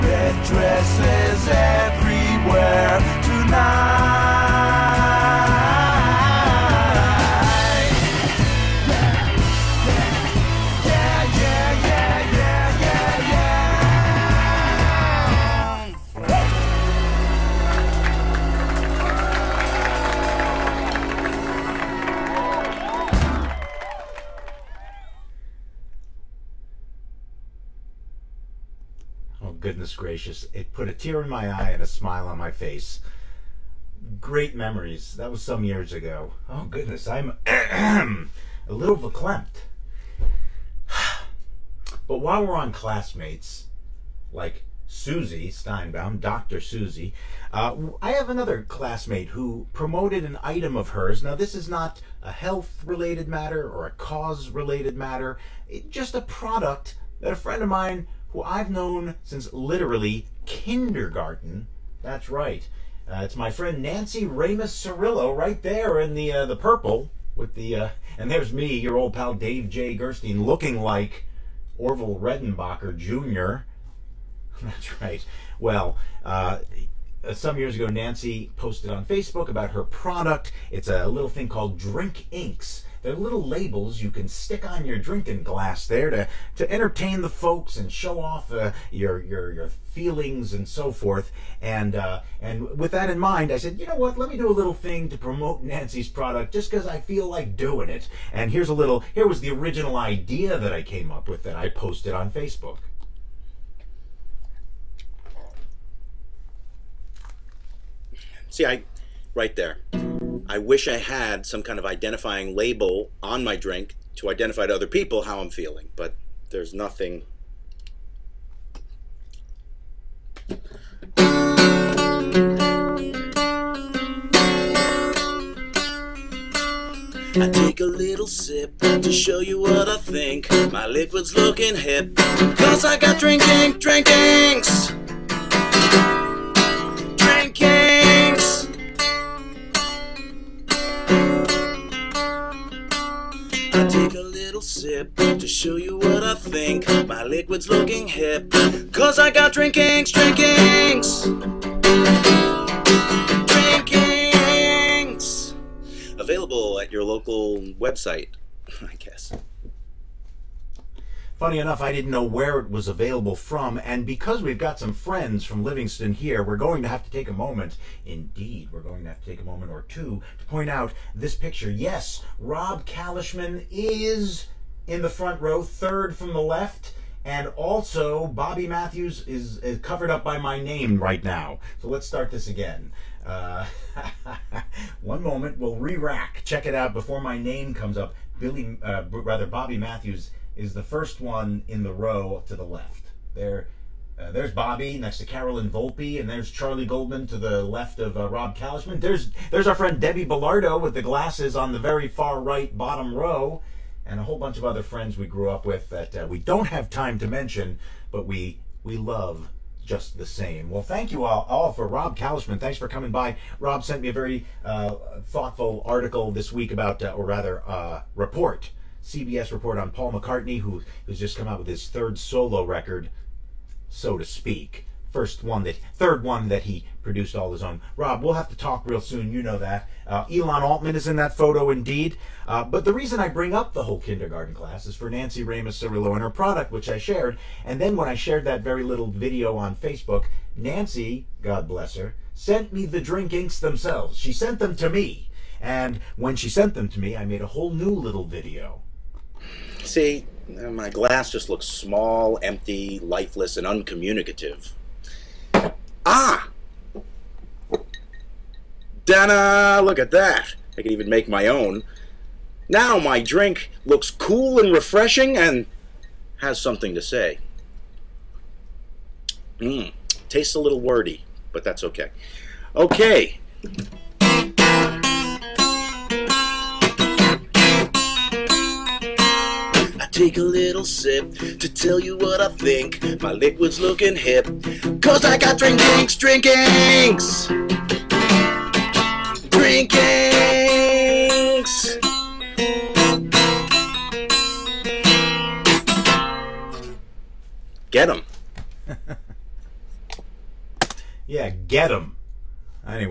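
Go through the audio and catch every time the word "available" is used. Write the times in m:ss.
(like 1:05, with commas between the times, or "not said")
2:36, 2:42.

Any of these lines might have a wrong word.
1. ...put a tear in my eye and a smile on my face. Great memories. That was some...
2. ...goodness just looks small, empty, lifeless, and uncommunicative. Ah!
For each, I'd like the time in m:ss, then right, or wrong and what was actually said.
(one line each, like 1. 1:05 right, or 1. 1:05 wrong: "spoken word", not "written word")
1. 0:30 right
2. 4:10 wrong: "glass", not "goodness".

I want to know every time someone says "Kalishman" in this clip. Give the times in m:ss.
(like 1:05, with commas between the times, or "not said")
2:52, 3:18, 3:32.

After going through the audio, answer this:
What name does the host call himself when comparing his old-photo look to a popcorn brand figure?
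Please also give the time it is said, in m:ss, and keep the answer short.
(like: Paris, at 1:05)
Dave Jay Gerstein, at 1:09.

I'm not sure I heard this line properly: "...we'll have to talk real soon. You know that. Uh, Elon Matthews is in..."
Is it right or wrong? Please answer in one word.
wrong.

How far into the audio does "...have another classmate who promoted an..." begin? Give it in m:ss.
0:48.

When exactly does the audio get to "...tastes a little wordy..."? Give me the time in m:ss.
4:30.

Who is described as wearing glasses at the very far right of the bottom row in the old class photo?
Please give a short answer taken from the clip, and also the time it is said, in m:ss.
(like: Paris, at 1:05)
Debbie Bellardo, at 3:19.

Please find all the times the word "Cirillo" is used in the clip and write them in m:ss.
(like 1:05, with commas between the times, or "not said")
1:04, 3:55.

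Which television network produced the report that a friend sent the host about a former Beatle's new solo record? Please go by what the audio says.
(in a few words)
CBS.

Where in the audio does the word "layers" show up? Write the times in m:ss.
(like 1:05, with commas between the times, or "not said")
not said.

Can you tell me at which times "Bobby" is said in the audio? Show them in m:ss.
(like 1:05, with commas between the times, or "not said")
2:58, 3:09, 3:14.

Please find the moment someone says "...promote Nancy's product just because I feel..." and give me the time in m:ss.
1:35.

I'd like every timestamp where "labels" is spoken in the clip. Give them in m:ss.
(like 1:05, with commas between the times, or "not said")
1:23, 1:52.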